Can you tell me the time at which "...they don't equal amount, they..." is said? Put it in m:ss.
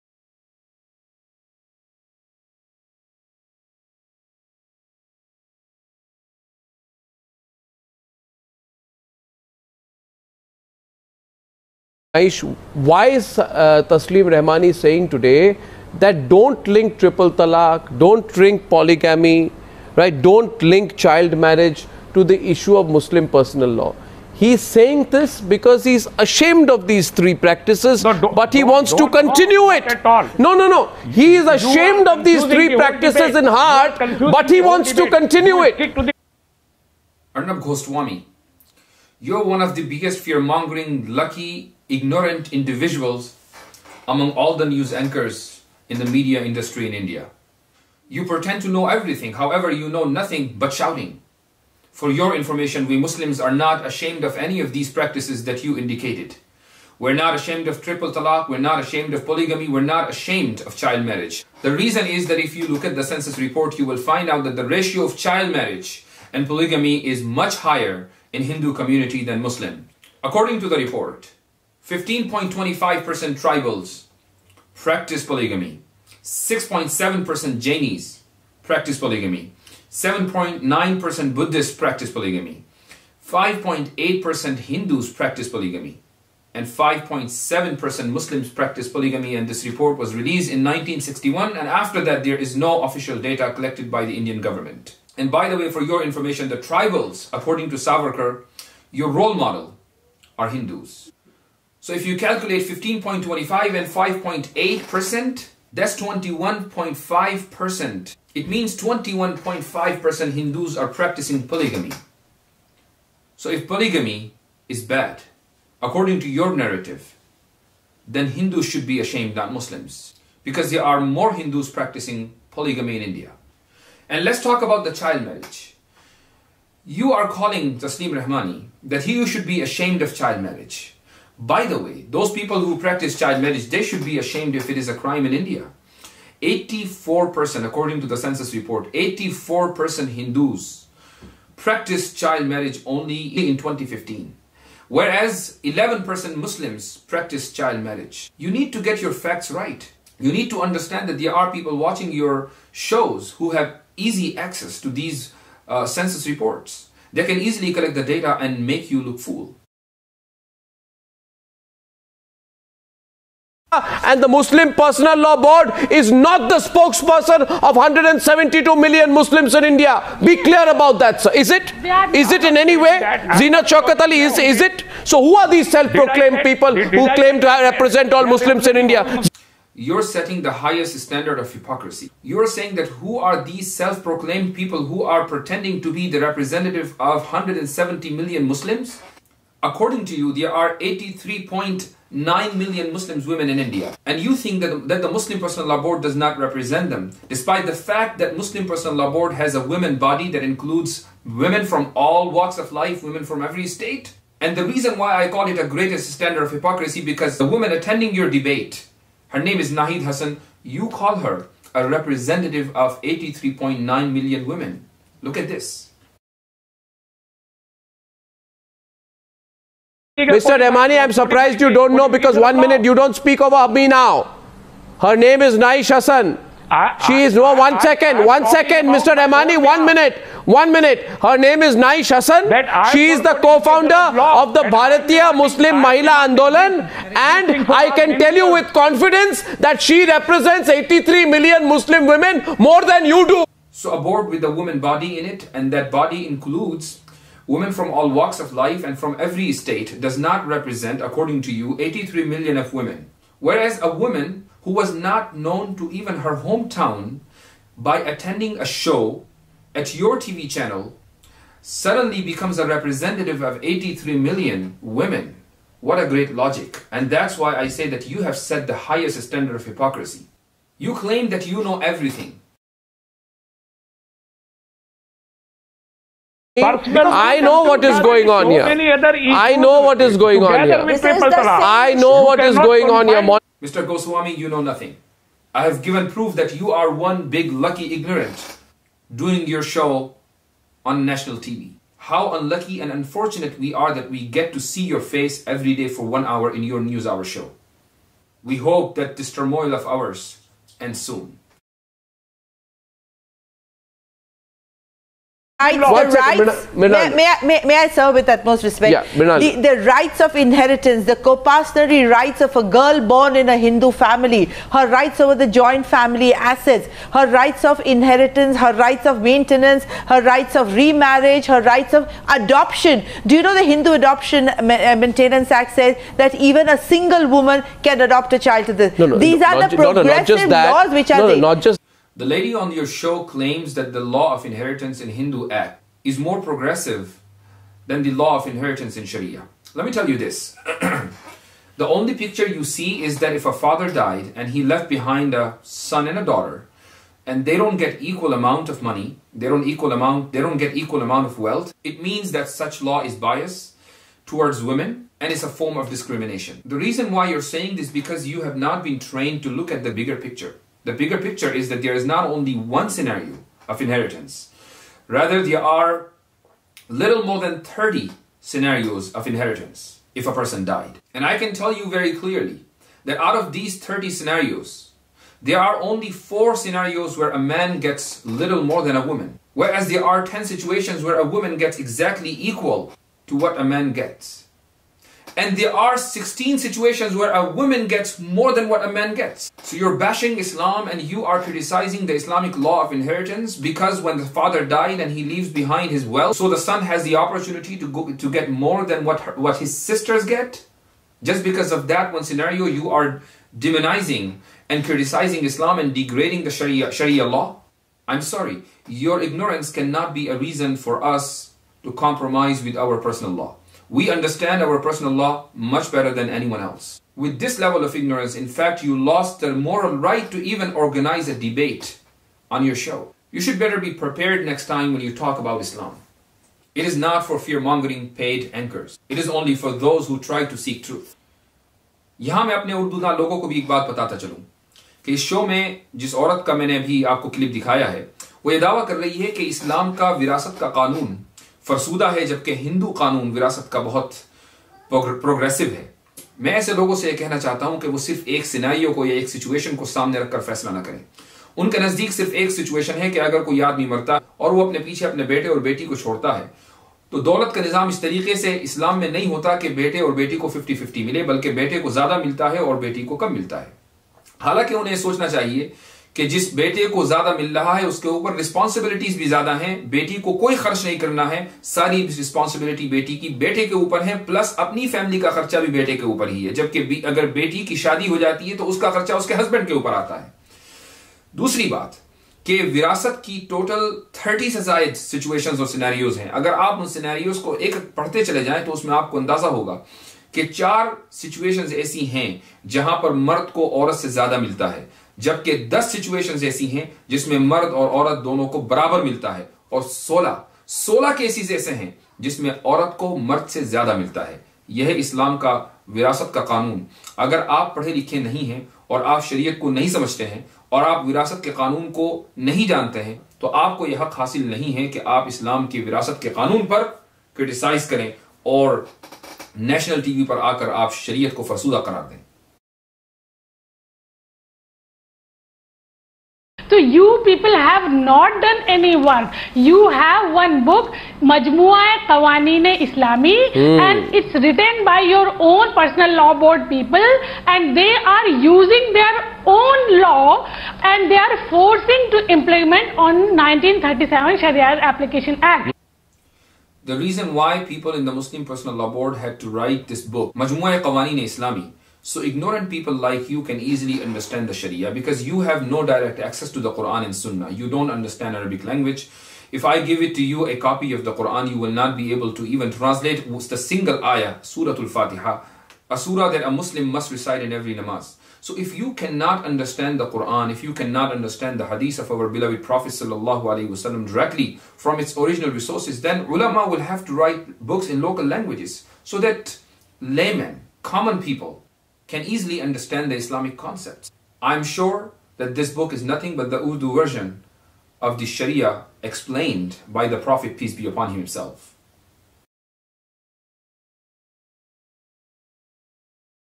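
5:49.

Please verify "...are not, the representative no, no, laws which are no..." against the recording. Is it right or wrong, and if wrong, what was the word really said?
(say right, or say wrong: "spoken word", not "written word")
wrong: "progressive", not "representative".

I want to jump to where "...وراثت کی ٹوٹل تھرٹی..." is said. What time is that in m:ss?
8:02.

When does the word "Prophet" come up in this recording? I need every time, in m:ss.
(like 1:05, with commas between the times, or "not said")
9:32, 9:50.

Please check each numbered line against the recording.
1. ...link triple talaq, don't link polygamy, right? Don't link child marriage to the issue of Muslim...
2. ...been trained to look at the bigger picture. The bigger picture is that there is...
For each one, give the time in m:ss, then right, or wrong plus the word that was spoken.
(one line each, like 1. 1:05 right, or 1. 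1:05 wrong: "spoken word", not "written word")
1. 0:16 right
2. 5:58 right.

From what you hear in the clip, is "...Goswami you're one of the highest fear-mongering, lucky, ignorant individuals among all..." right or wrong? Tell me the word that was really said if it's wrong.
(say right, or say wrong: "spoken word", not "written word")
wrong: "biggest", not "highest".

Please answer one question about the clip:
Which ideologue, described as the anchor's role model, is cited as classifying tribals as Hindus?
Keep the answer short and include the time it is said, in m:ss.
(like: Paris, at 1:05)
Savarkar, at 1:37.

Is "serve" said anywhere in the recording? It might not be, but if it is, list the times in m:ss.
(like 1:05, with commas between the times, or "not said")
5:07.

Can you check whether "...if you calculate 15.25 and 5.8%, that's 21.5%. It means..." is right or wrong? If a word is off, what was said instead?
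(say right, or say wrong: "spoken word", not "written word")
right.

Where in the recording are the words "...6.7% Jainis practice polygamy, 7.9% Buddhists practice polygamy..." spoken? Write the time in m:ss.
1:16.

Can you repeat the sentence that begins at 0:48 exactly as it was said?
You pretend to know everything, however, you know nothing but shouting.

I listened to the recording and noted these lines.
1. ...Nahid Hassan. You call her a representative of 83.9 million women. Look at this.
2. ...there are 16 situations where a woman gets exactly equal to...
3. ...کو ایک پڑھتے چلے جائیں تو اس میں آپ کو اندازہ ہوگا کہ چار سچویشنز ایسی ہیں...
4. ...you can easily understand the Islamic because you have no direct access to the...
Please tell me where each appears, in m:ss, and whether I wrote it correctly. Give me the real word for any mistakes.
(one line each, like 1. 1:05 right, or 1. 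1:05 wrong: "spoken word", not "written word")
1. 3:29 right
2. 6:19 wrong: "10", not "16"
3. 8:07 right
4. 9:13 wrong: "Sharia", not "Islamic".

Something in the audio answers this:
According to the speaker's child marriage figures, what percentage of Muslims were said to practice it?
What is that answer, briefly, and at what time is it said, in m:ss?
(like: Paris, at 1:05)
11%, at 2:25.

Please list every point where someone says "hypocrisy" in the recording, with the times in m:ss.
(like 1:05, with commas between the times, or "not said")
3:01, 3:26, 4:29.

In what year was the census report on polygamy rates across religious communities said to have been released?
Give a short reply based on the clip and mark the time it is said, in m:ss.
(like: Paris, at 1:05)
1961, at 1:30.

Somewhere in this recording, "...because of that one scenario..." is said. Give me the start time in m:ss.
6:41.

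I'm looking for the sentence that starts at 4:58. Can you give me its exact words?
We hope that this turmoil of ours ends soon.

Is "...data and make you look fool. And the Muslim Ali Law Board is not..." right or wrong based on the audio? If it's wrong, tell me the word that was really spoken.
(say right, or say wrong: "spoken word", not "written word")
wrong: "Personal", not "Ali".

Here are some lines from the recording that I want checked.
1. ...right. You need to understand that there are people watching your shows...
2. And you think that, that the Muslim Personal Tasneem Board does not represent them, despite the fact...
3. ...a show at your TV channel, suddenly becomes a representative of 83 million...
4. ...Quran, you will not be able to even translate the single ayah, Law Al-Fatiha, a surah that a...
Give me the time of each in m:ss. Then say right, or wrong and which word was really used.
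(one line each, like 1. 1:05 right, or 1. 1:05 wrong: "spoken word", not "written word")
1. 2:29 right
2. 3:14 wrong: "Law", not "Tasneem"
3. 4:18 right
4. 9:21 wrong: "Surah", not "Law".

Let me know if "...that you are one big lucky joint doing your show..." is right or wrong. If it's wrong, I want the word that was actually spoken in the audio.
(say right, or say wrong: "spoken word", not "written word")
wrong: "ignorant", not "joint".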